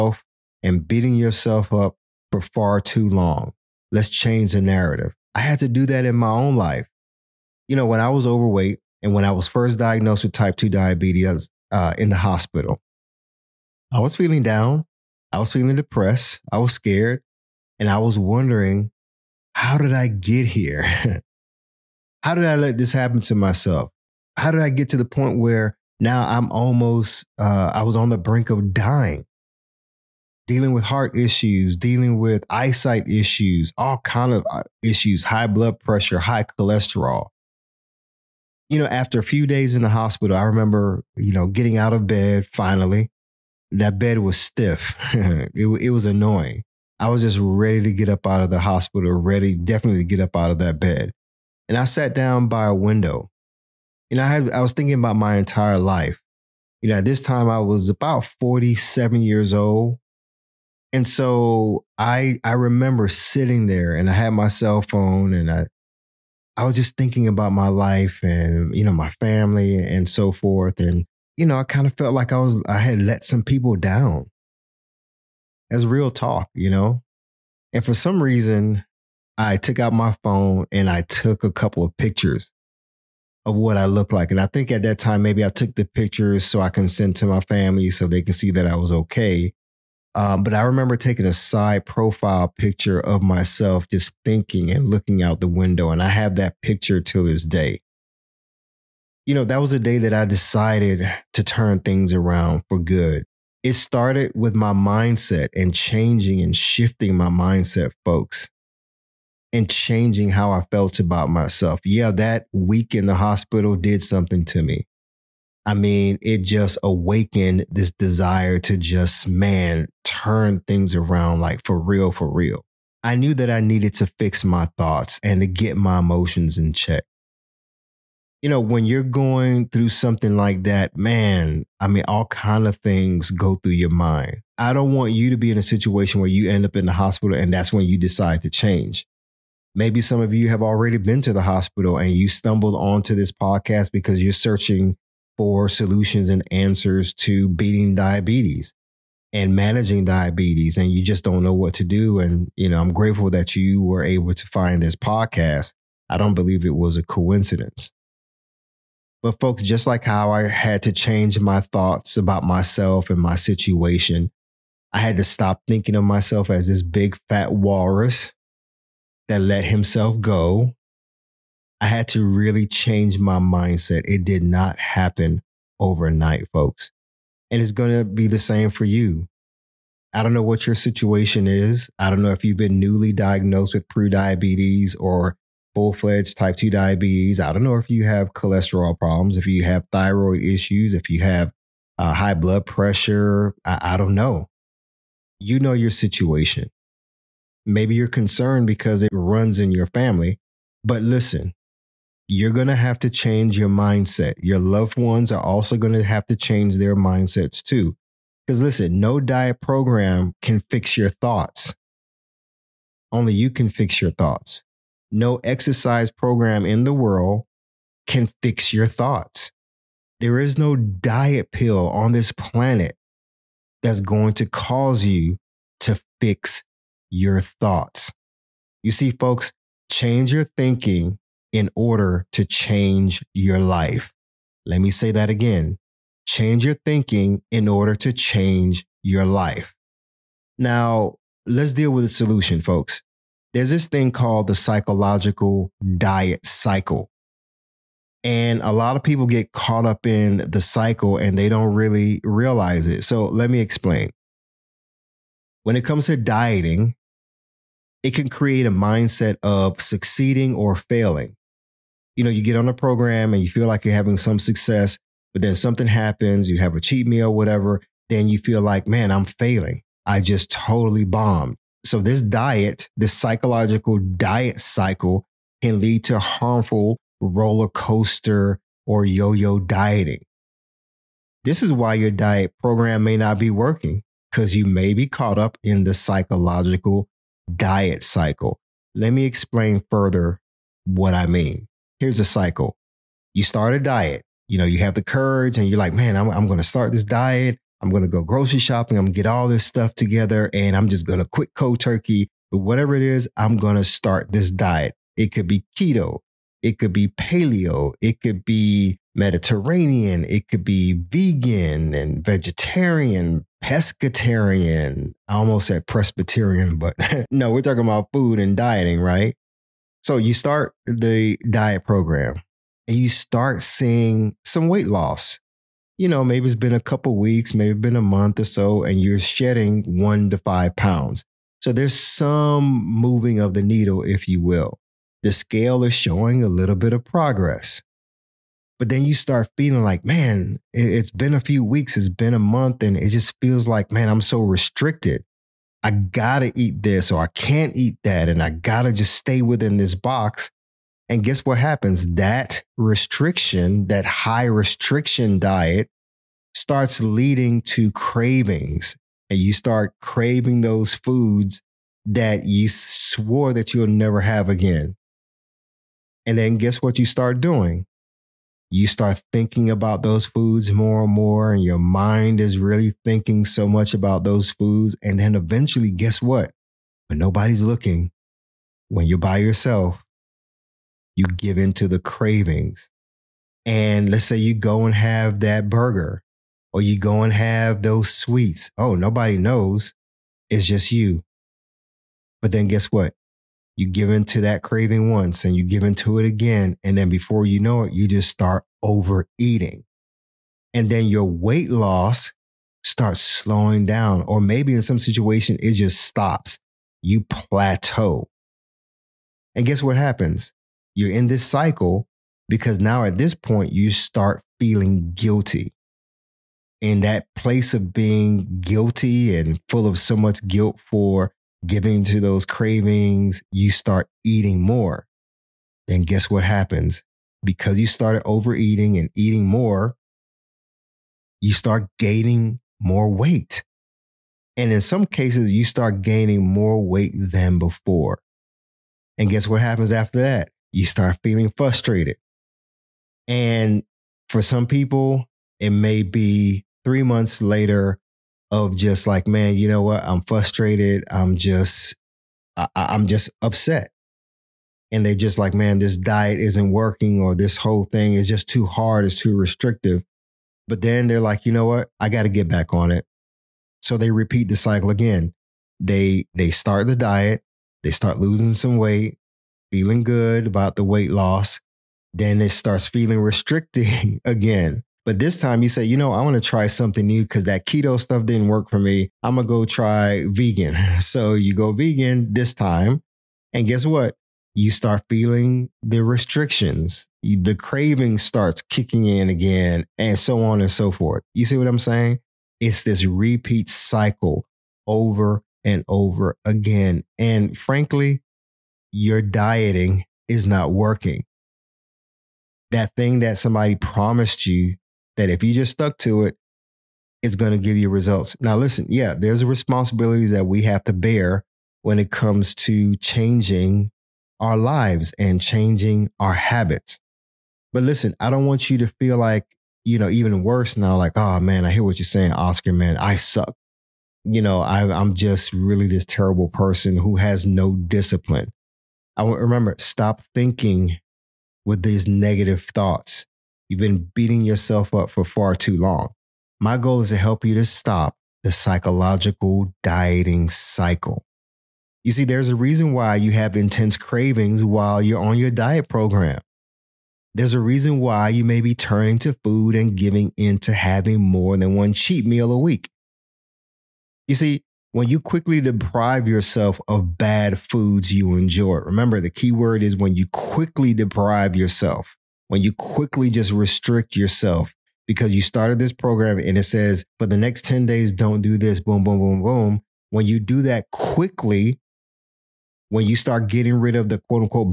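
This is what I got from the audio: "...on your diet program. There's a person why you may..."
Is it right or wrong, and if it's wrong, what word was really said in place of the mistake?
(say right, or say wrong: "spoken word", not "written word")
wrong: "reason", not "person".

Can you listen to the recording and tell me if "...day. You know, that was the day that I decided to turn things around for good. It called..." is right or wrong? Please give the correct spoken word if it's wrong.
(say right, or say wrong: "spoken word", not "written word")
wrong: "started", not "called".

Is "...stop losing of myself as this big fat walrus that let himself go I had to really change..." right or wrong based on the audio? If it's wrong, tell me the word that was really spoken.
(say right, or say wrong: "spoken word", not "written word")
wrong: "thinking", not "losing".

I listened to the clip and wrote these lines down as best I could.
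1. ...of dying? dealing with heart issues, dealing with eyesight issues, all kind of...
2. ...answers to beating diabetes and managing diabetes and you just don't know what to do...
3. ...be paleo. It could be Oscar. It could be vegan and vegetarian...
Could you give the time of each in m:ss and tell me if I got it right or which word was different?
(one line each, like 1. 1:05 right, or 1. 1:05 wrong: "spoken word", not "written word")
1. 0:28 right
2. 2:26 right
3. 5:06 wrong: "Mediterranean", not "Oscar".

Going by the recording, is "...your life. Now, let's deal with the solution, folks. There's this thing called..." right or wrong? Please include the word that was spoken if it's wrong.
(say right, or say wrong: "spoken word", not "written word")
right.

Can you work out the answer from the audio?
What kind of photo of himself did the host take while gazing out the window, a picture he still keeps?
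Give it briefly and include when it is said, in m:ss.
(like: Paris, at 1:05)
side profile, at 1:31.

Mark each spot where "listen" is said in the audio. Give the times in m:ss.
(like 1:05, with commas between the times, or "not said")
3:21, 3:28, 8:28, 8:37.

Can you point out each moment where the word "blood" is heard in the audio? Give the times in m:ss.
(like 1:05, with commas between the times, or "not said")
0:35, 3:12.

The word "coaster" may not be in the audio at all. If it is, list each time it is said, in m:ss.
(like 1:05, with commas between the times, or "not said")
4:37.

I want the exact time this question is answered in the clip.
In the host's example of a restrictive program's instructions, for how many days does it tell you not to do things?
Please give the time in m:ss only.
9:27.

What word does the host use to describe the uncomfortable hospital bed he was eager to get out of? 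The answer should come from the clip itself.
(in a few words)
stiff.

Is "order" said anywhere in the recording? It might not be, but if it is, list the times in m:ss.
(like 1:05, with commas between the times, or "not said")
3:51, 3:57.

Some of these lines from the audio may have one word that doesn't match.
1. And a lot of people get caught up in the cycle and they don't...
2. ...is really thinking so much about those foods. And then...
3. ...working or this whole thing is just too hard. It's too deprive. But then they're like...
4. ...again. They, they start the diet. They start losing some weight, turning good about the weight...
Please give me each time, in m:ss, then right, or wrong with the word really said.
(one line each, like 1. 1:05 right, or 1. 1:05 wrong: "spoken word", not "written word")
1. 4:08 right
2. 6:12 right
3. 7:36 wrong: "restrictive", not "deprive"
4. 7:44 wrong: "feeling", not "turning".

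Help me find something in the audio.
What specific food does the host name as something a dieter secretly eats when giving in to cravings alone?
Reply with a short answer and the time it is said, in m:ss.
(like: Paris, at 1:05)
burger, at 6:25.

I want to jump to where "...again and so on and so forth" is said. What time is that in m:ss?
8:09.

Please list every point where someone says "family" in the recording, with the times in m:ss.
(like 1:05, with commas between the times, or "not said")
1:09, 1:27, 3:19.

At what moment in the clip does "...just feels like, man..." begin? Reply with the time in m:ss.
5:43.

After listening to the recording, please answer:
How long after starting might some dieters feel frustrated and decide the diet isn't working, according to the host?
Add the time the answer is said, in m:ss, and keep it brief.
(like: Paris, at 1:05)
3 months, at 7:26.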